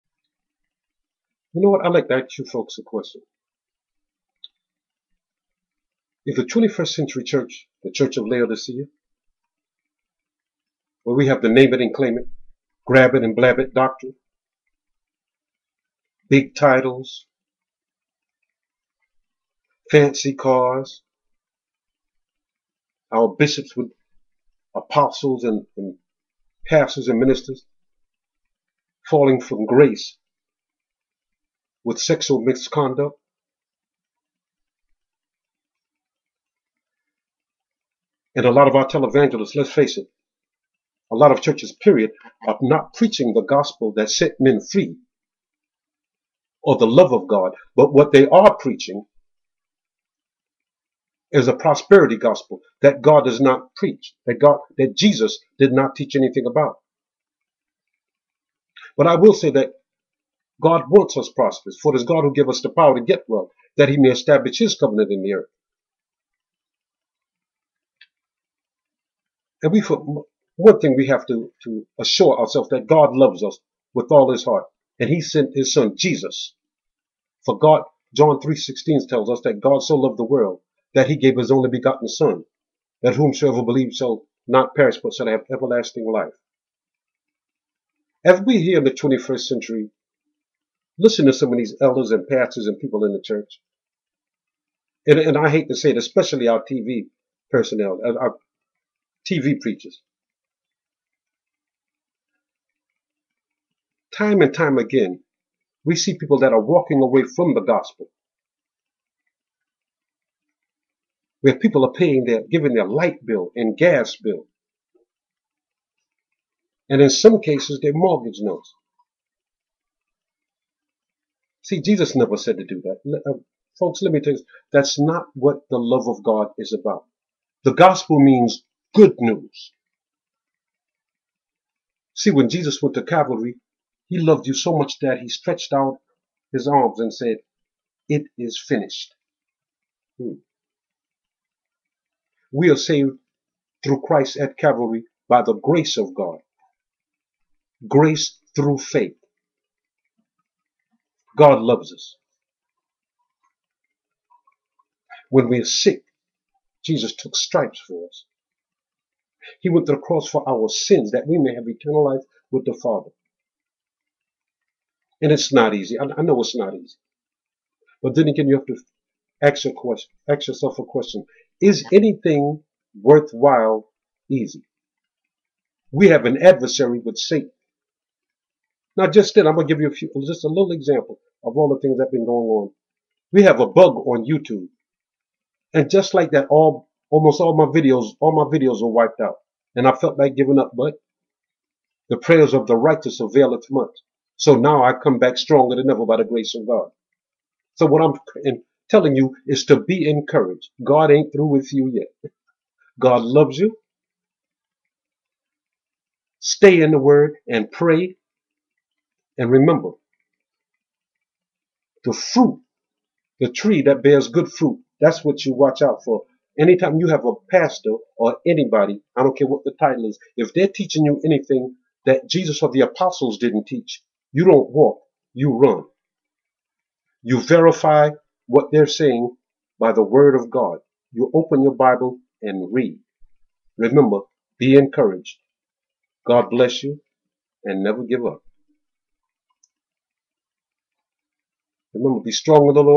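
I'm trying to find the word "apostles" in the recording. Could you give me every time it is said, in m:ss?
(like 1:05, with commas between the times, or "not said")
0:24, 3:42.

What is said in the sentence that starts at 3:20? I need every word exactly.
God ain't through with you yet.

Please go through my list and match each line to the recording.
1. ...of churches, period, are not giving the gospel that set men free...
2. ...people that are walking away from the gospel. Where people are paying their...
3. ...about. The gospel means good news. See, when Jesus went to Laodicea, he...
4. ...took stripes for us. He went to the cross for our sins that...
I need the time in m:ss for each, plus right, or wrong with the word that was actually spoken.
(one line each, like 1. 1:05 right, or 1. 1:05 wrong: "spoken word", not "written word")
1. 0:41 wrong: "preaching", not "giving"
2. 1:46 right
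3. 2:06 wrong: "Calvary", not "Laodicea"
4. 2:37 right.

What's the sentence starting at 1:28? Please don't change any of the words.
As we here in the 21st century listen to some of these elders and pastors and people in the church.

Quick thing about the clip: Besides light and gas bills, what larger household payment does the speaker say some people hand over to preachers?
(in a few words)
Mortgage notes.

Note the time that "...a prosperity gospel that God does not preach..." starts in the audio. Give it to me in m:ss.
0:51.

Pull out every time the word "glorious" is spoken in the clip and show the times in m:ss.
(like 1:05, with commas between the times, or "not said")
not said.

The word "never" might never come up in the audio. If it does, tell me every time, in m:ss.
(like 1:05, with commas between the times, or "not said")
2:02, 3:57.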